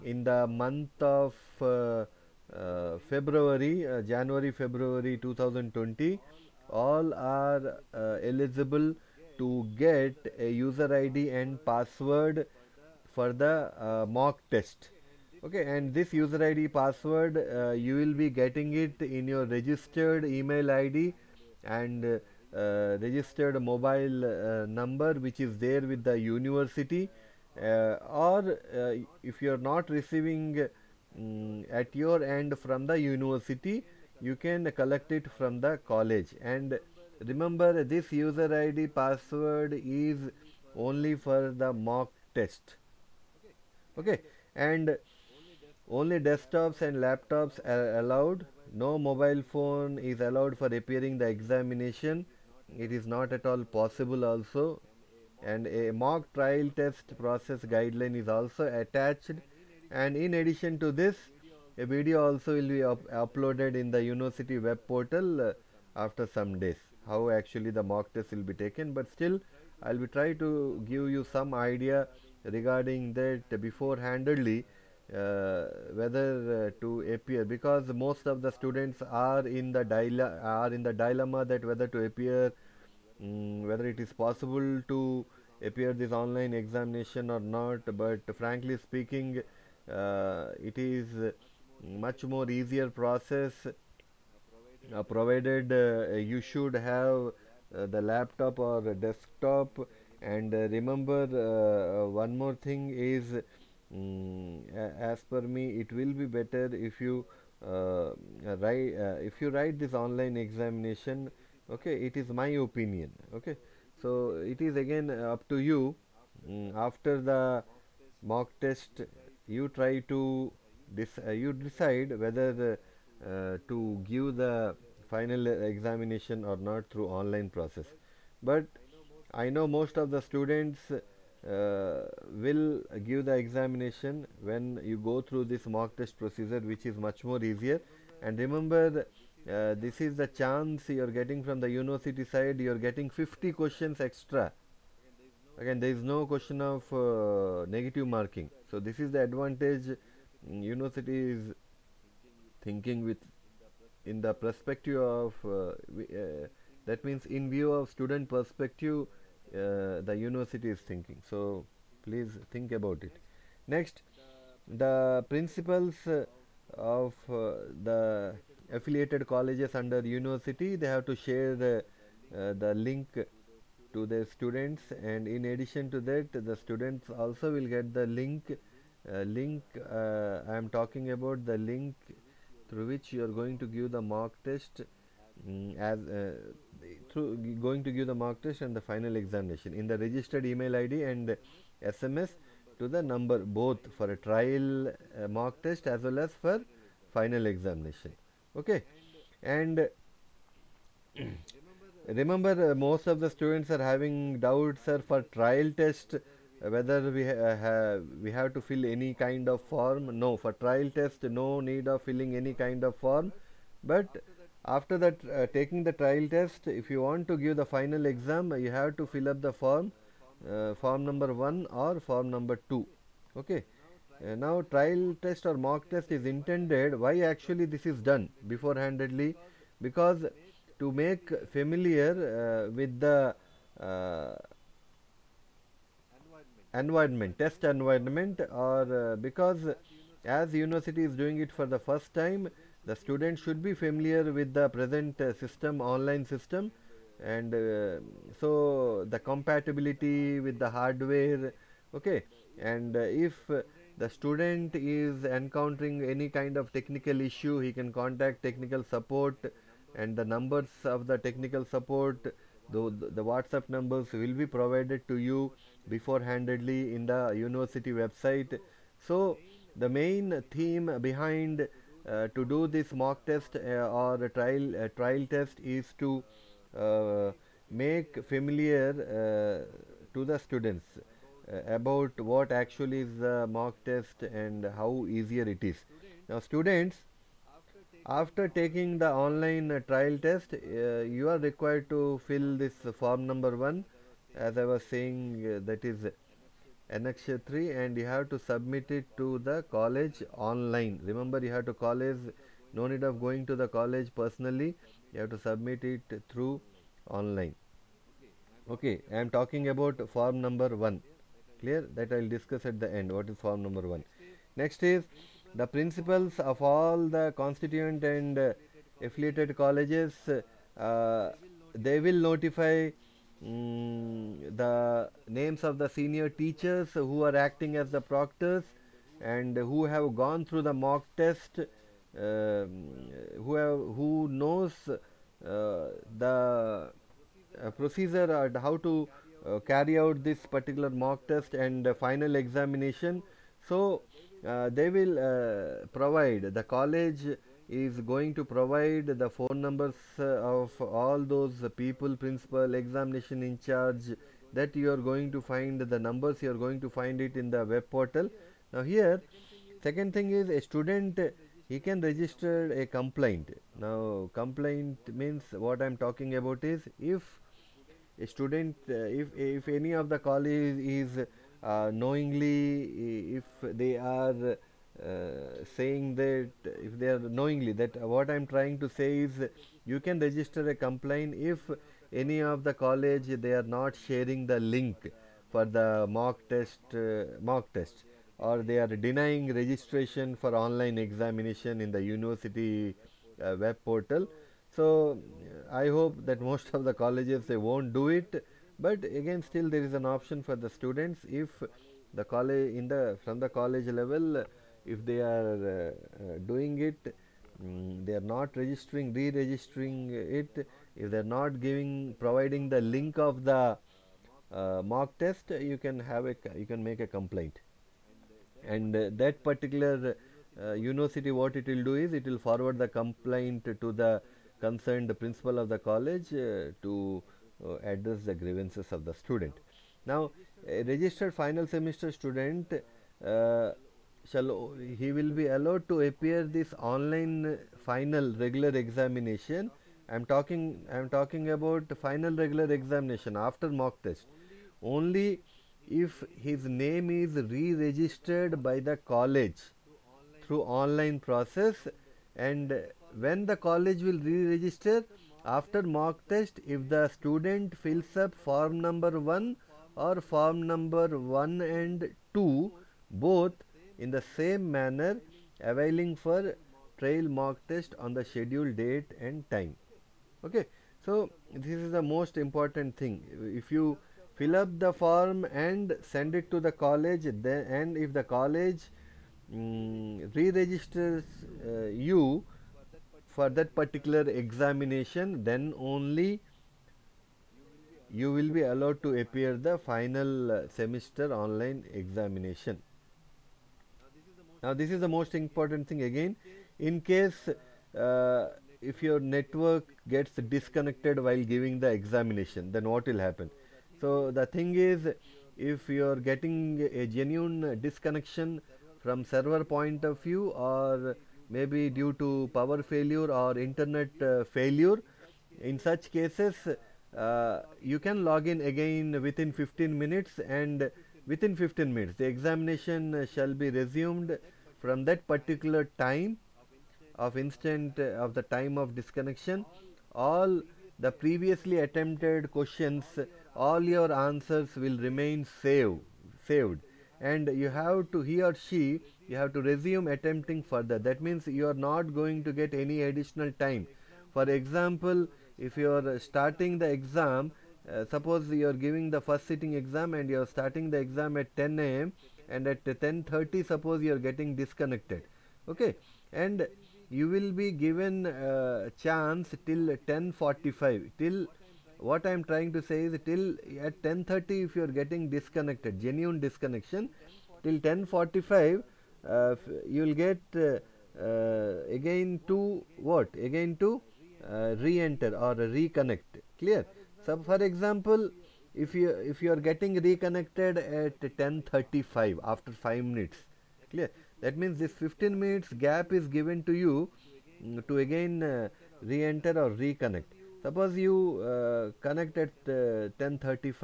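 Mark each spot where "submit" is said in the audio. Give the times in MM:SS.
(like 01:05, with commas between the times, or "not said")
04:58, 05:05.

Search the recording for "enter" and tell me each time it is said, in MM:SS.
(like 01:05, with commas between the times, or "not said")
09:34, 09:49.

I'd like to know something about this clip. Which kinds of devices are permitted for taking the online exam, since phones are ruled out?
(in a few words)
desktops and laptops.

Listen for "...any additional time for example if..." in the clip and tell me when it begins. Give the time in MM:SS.
09:02.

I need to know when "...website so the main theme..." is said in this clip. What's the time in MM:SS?
04:27.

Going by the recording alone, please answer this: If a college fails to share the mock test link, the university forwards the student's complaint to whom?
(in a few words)
the concerned principal.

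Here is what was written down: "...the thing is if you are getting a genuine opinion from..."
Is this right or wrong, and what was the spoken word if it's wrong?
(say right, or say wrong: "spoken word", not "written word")
wrong: "disconnection", not "opinion".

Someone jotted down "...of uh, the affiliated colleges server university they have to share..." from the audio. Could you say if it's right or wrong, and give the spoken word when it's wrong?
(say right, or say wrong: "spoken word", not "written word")
wrong: "under", not "server".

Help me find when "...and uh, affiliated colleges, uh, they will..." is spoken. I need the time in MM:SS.
05:18.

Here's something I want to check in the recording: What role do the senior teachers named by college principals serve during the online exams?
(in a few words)
proctors.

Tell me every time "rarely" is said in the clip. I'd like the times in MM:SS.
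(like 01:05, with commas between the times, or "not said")
not said.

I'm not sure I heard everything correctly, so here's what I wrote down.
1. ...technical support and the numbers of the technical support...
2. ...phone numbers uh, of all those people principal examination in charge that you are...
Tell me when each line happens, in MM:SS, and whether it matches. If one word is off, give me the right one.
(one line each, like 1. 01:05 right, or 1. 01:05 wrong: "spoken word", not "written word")
1. 04:18 right
2. 05:49 right.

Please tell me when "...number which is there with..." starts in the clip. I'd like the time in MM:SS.
00:24.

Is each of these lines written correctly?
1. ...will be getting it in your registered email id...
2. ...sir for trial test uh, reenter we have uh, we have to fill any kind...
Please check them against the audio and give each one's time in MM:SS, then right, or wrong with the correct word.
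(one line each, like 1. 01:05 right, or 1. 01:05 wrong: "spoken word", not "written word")
1. 00:17 right
2. 03:24 wrong: "whether", not "reenter".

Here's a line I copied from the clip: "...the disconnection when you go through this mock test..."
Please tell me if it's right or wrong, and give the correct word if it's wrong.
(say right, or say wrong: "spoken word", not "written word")
wrong: "examination", not "disconnection".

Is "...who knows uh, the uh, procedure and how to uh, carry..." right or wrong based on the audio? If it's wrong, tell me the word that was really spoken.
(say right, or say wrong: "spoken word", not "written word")
right.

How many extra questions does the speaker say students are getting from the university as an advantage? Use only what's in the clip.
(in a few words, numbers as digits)
50.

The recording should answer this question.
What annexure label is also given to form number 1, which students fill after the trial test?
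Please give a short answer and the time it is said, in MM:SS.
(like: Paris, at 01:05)
annex 3, at 04:56.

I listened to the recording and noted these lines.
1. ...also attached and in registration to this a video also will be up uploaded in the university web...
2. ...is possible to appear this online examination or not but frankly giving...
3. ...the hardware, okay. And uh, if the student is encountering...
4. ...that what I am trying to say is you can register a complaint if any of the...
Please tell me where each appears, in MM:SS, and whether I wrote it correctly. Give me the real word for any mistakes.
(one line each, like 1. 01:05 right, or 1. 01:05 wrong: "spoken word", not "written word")
1. 00:58 wrong: "addition", not "registration"
2. 01:23 wrong: "speaking", not "giving"
3. 04:10 right
4. 06:17 right.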